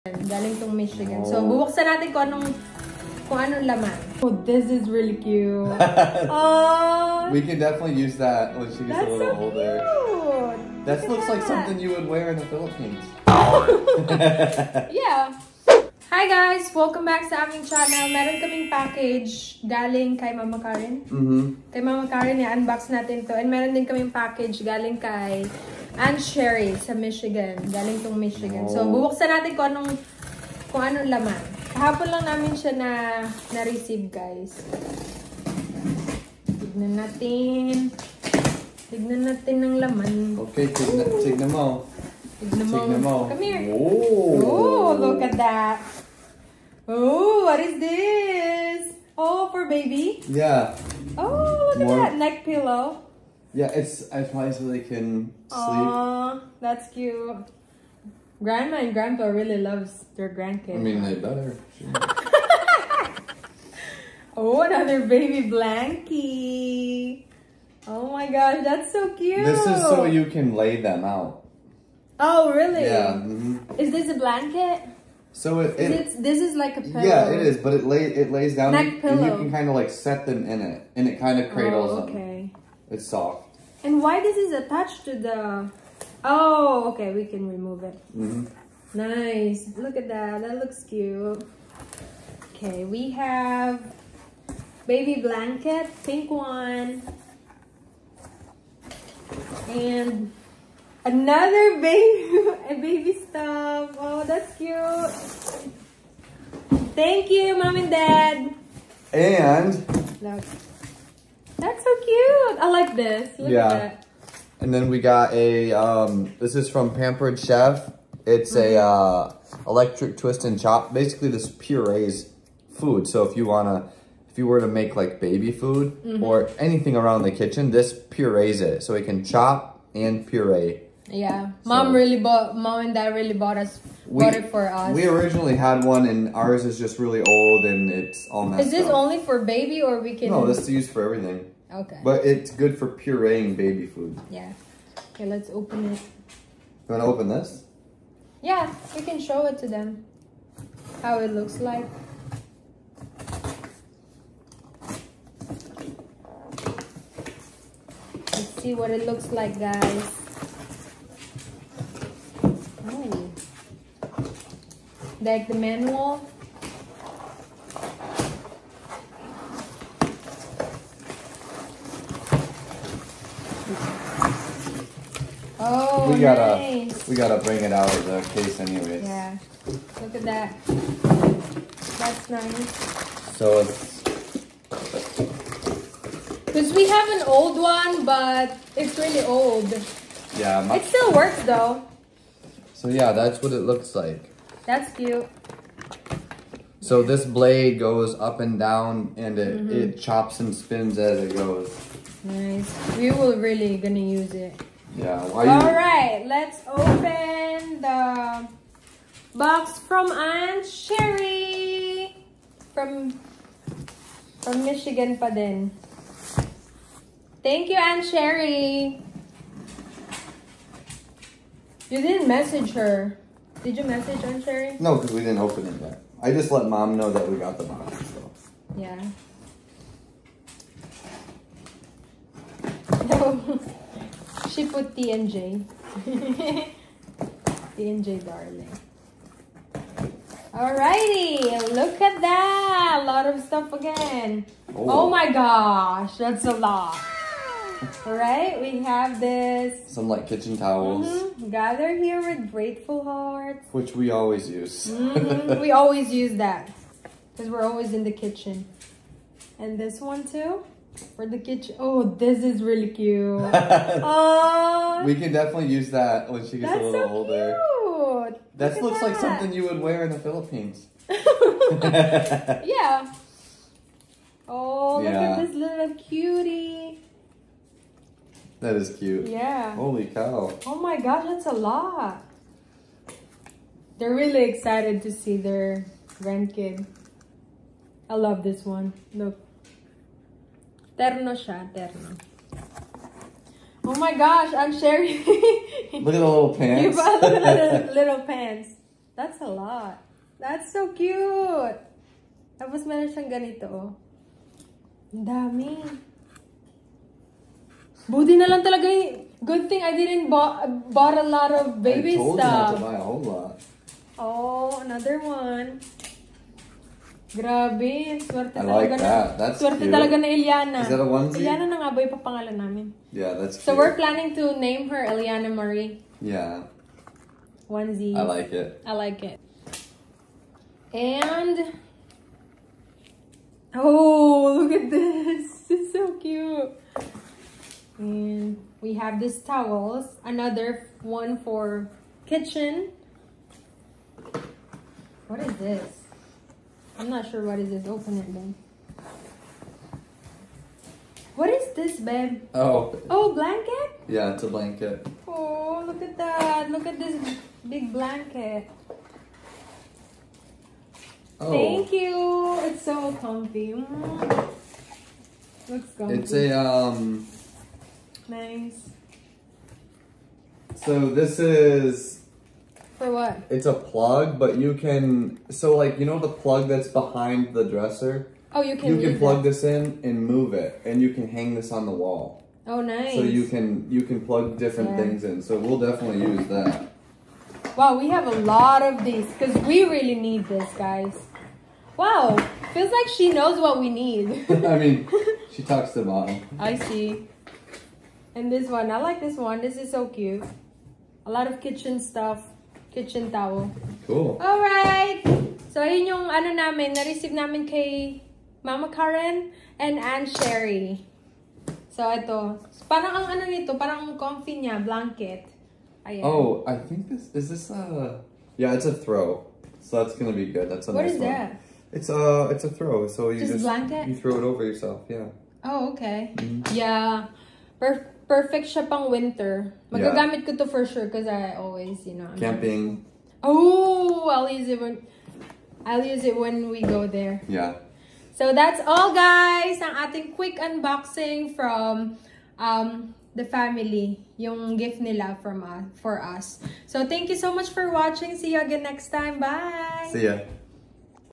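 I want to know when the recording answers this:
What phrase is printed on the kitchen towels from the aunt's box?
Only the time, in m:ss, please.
4:11.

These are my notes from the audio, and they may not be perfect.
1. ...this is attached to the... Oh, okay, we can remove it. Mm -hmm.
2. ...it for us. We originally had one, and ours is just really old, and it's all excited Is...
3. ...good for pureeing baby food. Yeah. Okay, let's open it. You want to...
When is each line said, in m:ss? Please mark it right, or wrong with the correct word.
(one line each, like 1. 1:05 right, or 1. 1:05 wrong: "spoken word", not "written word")
1. 1:24 right
2. 2:14 wrong: "messed", not "excited"
3. 2:22 right.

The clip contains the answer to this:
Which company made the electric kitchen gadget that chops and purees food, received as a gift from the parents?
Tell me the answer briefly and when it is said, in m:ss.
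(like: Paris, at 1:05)
Pampered Chef, at 1:56.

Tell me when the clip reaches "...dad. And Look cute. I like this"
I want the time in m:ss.
1:48.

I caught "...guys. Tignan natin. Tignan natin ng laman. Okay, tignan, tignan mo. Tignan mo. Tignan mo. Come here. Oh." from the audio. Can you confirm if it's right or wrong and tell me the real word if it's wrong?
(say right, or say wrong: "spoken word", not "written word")
right.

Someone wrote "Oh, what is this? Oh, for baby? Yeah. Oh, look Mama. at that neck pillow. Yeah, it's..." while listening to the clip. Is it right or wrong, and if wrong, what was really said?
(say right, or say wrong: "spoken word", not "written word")
wrong: "More", not "Mama".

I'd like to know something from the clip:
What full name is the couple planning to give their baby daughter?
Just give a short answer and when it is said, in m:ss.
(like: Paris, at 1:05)
Eliana Marie, at 5:25.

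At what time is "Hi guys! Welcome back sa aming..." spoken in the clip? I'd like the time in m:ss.
0:16.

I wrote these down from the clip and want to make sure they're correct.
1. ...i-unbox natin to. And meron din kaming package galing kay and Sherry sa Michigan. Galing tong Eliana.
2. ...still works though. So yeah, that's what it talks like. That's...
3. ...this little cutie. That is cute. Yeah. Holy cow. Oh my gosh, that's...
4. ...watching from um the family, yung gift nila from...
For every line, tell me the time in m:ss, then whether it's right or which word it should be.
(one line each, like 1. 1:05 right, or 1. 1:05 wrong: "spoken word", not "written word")
1. 0:22 wrong: "Michigan", not "Eliana"
2. 3:10 wrong: "looks", not "talks"
3. 4:35 right
4. 7:20 wrong: "unboxing", not "watching".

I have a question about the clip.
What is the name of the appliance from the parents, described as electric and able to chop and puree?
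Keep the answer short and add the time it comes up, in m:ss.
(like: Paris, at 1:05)
Electric twist and chop, at 1:59.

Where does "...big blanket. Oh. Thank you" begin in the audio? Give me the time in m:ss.
5:57.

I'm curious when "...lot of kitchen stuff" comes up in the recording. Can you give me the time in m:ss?
6:41.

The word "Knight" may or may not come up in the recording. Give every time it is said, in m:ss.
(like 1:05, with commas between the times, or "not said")
not said.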